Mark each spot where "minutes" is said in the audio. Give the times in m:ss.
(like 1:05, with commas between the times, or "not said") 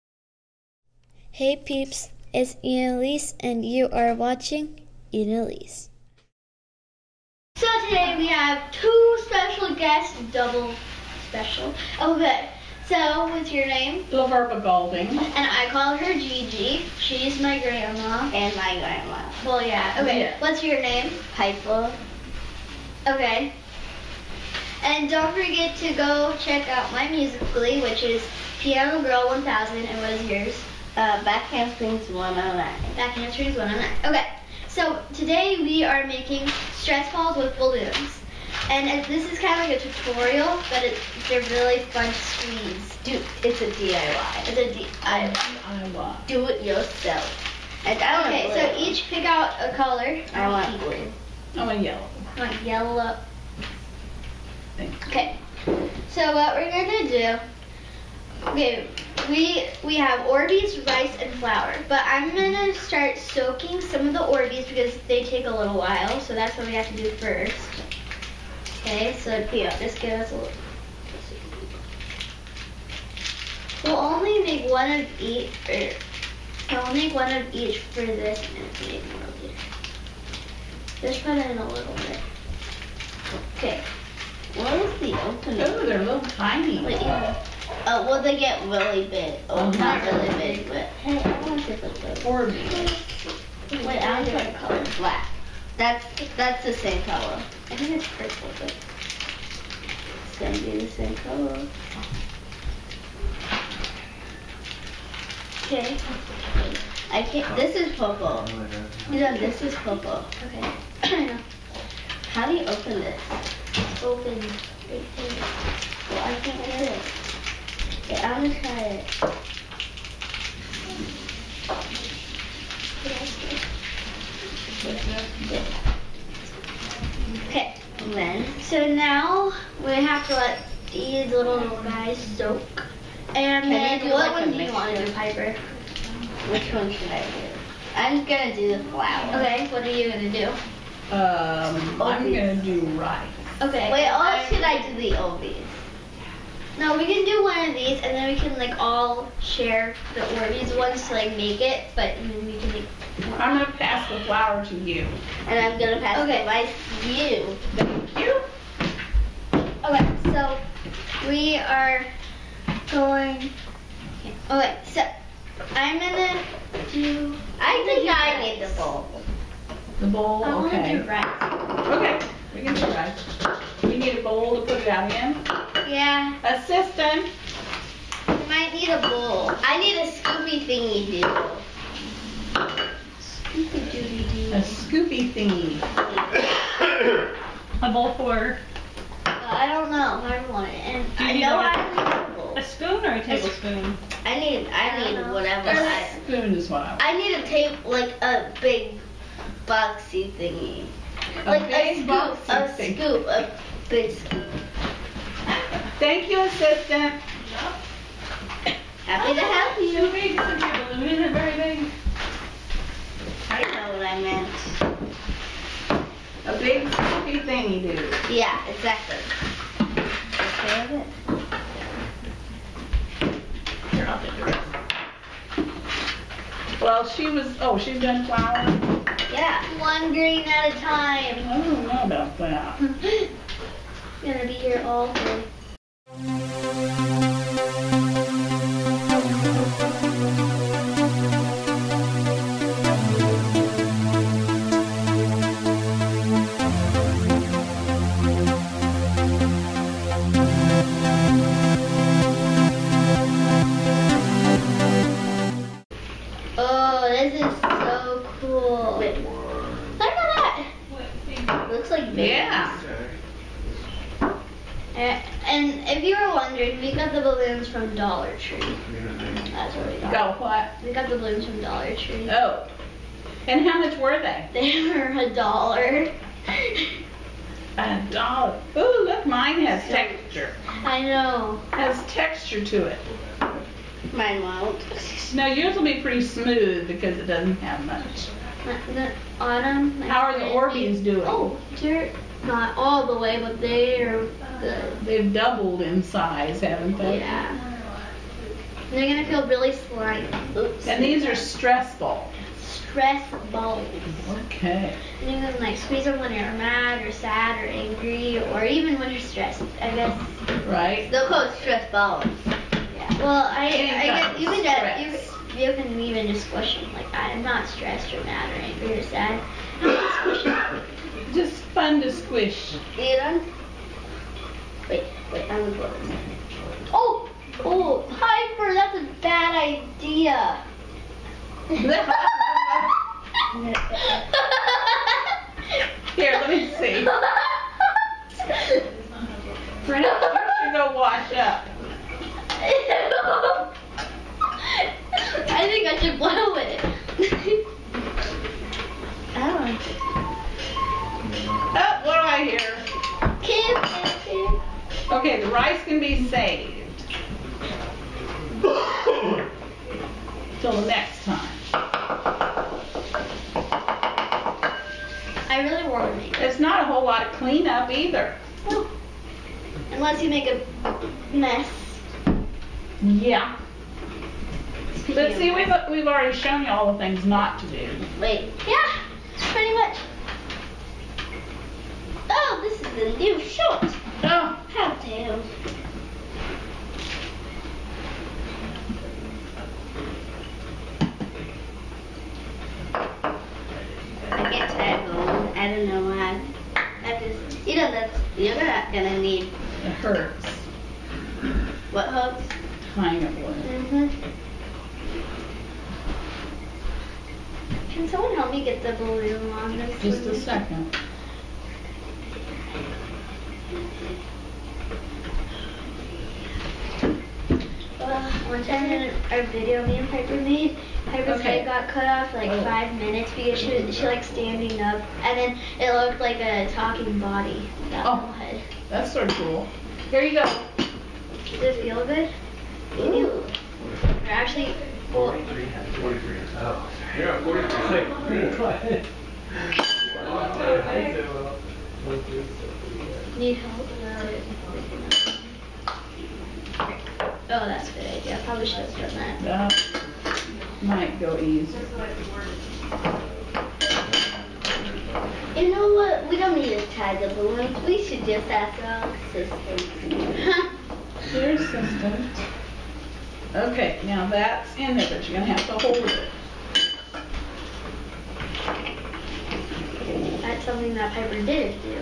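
7:02.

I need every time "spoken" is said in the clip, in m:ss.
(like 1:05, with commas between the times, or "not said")
not said.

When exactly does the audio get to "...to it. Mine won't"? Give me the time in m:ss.
4:42.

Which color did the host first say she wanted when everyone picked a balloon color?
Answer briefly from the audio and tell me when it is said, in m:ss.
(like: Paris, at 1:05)
blue, at 0:50.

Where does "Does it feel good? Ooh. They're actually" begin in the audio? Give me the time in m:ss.
7:10.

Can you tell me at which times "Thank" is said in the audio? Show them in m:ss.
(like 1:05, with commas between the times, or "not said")
2:37, 3:26.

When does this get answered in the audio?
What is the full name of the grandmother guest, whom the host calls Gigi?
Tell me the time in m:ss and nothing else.
0:14.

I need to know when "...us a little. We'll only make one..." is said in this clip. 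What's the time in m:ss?
1:10.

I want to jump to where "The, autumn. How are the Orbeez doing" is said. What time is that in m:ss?
4:48.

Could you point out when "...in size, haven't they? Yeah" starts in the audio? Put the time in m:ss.
4:55.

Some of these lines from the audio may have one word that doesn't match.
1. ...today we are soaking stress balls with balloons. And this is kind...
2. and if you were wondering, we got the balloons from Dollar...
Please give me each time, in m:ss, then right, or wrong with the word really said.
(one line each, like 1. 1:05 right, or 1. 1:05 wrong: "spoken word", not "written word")
1. 0:35 wrong: "making", not "soaking"
2. 4:25 right.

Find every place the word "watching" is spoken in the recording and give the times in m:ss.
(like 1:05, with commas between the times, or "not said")
0:04.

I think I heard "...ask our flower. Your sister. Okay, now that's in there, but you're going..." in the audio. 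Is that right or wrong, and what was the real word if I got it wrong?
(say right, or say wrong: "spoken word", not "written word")
wrong: "sister", not "flower".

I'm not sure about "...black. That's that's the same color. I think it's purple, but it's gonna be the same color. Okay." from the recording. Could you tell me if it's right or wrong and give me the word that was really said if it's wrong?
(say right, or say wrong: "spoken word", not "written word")
right.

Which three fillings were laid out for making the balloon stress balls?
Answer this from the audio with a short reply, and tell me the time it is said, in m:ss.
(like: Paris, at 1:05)
Orbeez, rice, and flour, at 1:00.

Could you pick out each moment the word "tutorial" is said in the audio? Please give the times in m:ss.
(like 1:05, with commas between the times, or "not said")
0:39.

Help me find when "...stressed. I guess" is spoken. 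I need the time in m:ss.
5:09.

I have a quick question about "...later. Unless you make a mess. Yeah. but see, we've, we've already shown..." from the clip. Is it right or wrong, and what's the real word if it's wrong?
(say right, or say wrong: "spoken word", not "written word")
wrong: "either", not "later".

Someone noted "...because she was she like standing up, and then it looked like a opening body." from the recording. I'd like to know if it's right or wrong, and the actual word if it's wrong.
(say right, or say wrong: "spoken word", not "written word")
wrong: "talking", not "opening".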